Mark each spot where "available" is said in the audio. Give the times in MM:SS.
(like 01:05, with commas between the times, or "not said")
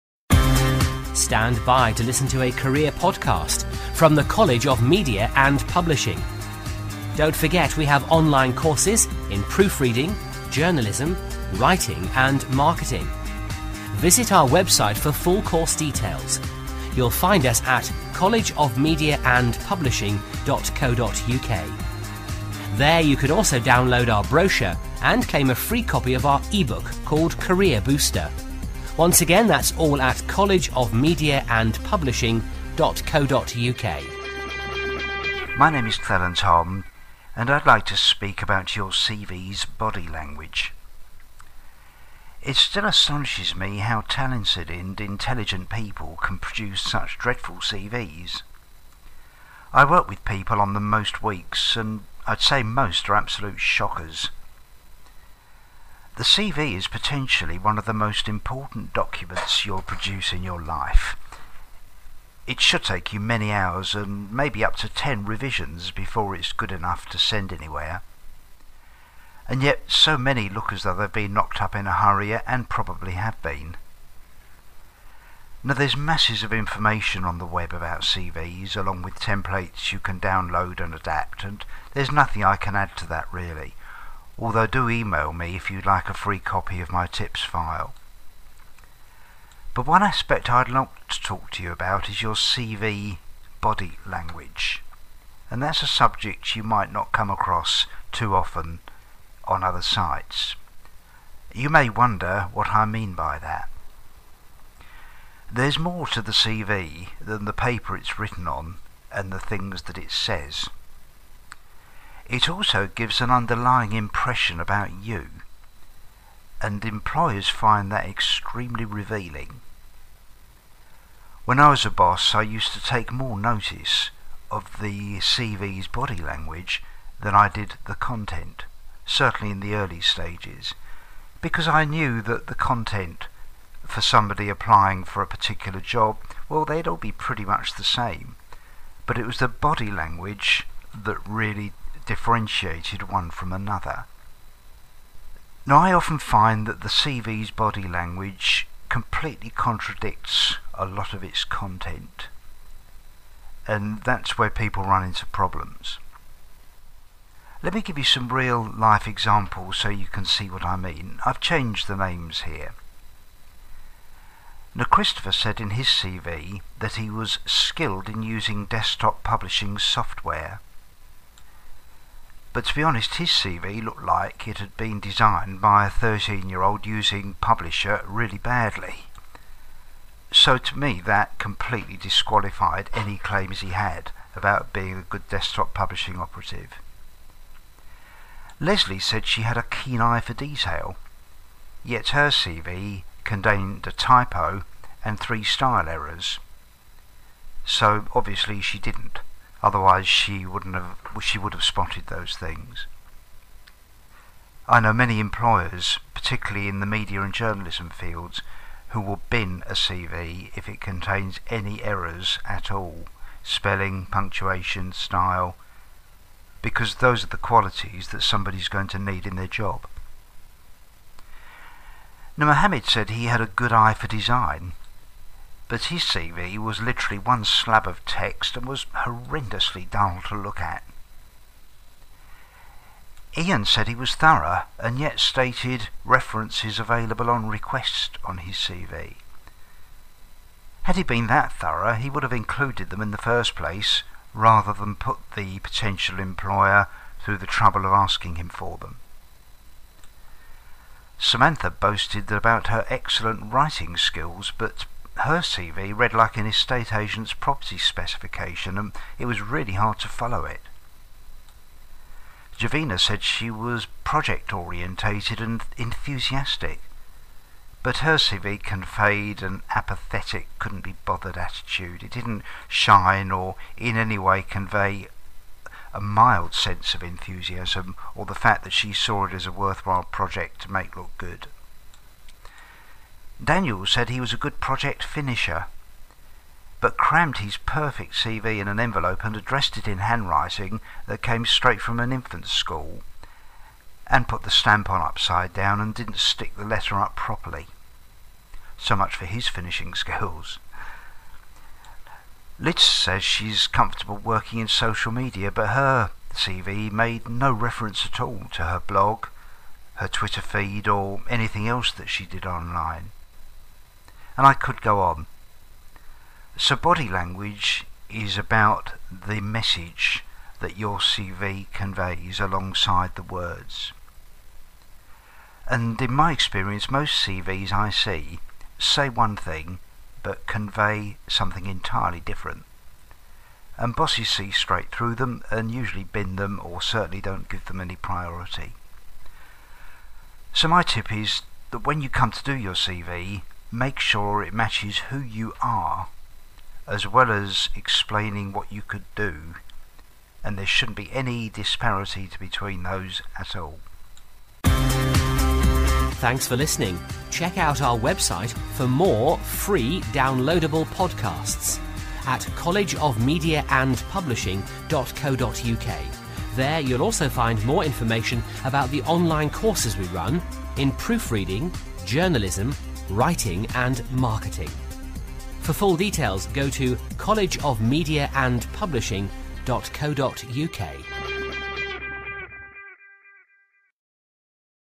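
03:56.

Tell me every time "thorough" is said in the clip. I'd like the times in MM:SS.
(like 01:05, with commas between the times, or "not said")
03:54, 04:01.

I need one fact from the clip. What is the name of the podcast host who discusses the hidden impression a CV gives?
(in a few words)
Clarence Tom.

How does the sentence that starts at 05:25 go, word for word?
And in my experience, most CVs I see say one thing but convey something entirely different.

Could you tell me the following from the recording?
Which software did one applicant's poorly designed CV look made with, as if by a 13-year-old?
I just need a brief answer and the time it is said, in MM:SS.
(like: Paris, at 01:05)
Publisher, at 02:57.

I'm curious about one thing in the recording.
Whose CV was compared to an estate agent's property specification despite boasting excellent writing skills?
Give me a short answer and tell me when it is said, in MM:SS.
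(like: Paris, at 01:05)
Samantha, at 04:11.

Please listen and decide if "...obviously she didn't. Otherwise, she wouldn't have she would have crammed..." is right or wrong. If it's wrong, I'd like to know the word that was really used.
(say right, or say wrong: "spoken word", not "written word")
wrong: "spotted", not "crammed".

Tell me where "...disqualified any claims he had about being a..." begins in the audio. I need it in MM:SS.
03:01.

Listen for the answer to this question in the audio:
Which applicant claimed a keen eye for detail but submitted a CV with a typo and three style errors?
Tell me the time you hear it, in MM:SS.
03:08.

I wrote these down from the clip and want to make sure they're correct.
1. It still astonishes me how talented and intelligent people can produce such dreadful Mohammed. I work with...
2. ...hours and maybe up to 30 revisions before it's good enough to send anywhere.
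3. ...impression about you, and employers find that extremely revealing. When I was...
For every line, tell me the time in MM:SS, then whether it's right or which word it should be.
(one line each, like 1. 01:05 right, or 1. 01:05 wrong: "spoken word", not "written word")
1. 00:42 wrong: "CVs", not "Mohammed"
2. 01:03 wrong: "10", not "30"
3. 01:53 right.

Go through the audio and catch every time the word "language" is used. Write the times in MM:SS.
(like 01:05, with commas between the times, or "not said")
00:40, 01:34, 02:06, 02:19, 02:27, 05:17.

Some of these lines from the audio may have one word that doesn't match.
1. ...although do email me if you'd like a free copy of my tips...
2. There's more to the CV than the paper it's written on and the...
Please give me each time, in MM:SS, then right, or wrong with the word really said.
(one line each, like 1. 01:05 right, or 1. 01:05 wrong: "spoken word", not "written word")
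1. 01:24 right
2. 01:45 right.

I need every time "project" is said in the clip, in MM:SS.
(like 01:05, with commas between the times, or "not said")
04:24, 04:40, 04:44.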